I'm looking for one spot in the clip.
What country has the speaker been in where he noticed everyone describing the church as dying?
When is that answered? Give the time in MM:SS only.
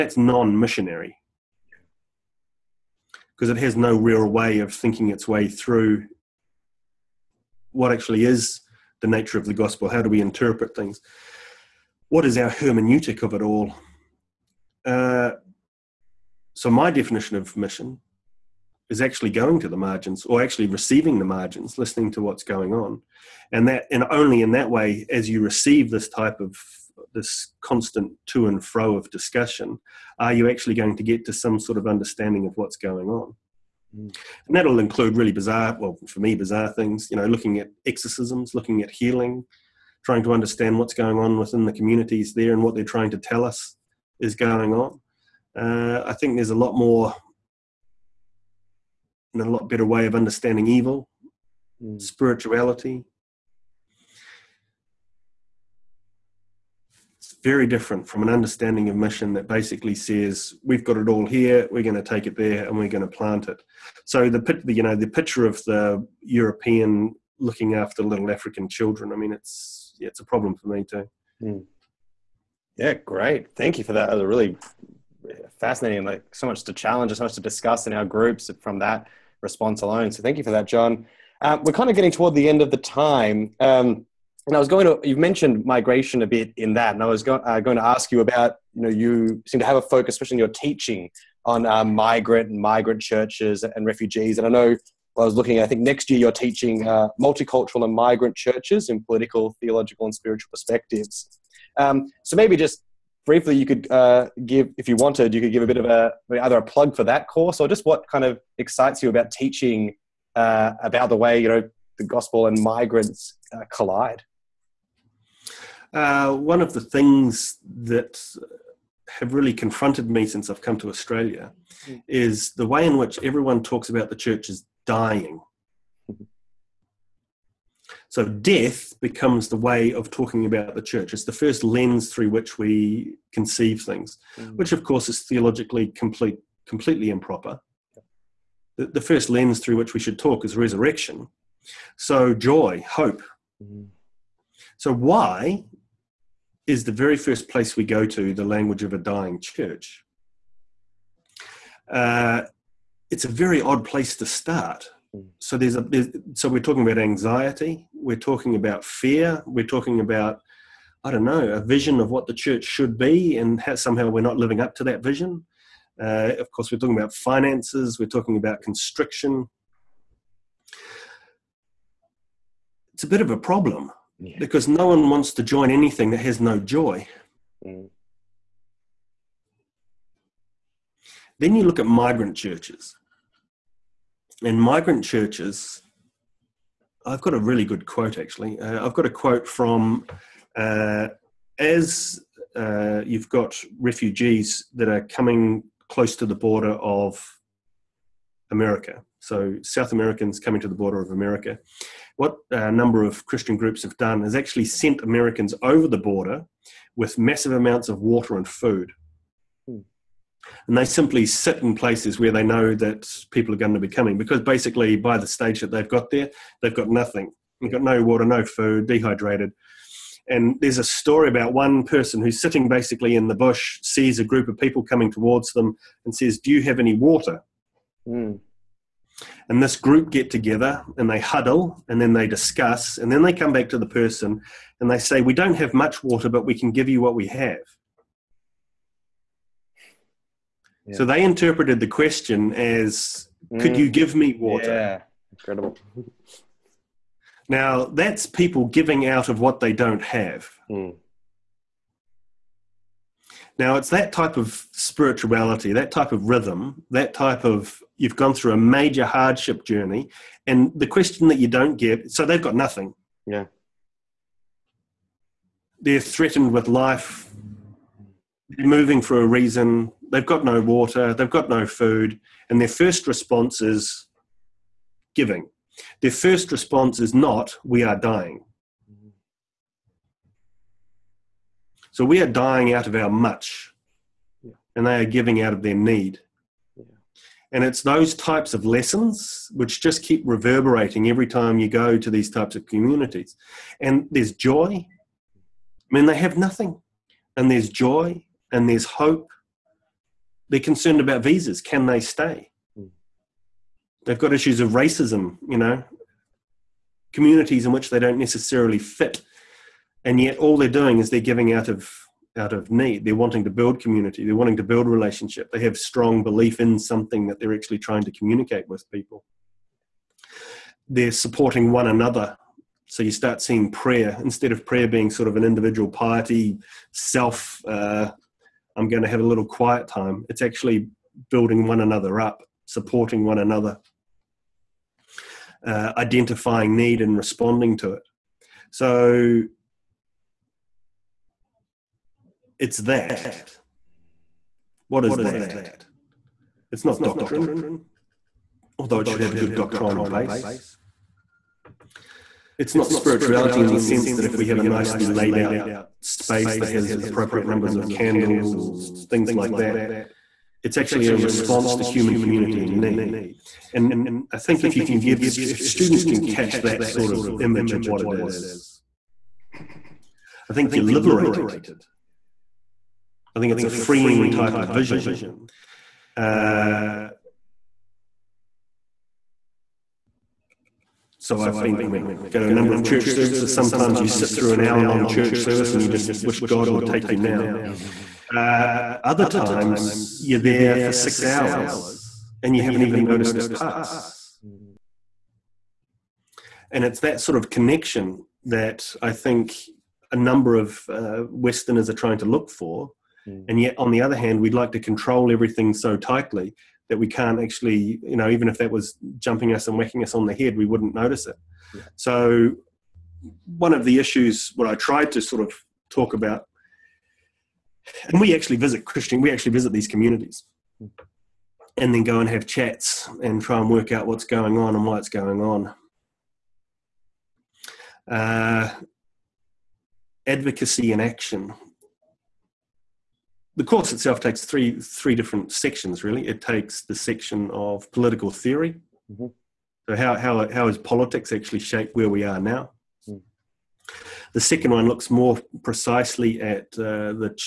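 02:00.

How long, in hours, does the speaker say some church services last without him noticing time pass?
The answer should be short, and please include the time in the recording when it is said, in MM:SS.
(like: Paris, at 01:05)
6 hours, at 06:30.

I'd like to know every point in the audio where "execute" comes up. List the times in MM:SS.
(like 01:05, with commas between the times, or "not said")
not said.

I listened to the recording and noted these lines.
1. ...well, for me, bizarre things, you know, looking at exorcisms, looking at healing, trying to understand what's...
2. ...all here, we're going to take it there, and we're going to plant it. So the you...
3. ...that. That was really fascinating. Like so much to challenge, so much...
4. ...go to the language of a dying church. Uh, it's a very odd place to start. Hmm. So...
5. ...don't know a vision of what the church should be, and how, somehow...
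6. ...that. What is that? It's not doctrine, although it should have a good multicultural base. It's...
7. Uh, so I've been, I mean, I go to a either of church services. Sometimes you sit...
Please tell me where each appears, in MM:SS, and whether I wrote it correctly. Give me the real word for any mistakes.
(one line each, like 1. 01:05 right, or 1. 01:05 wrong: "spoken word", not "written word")
1. 00:35 right
2. 01:01 right
3. 01:13 right
4. 02:27 right
5. 02:41 right
6. 05:42 wrong: "doctrinal", not "multicultural"
7. 06:16 wrong: "number", not "either".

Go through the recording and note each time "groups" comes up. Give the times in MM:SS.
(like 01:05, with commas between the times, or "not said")
01:18, 03:23, 03:44, 03:49.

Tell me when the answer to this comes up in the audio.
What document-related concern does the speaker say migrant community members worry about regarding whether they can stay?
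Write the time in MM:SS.
05:01.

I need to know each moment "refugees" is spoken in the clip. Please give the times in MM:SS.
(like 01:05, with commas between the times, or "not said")
01:33, 03:13.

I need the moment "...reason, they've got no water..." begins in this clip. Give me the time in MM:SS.
04:29.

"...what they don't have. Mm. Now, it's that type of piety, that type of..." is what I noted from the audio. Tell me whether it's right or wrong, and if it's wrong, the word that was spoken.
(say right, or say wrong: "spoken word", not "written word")
wrong: "spirituality", not "piety".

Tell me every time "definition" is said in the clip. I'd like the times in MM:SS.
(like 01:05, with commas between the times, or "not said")
00:16.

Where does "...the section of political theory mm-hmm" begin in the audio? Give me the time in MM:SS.
07:16.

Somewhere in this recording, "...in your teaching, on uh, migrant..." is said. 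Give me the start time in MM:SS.
01:30.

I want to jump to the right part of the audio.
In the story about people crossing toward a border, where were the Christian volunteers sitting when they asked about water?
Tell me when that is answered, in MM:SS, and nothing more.
03:43.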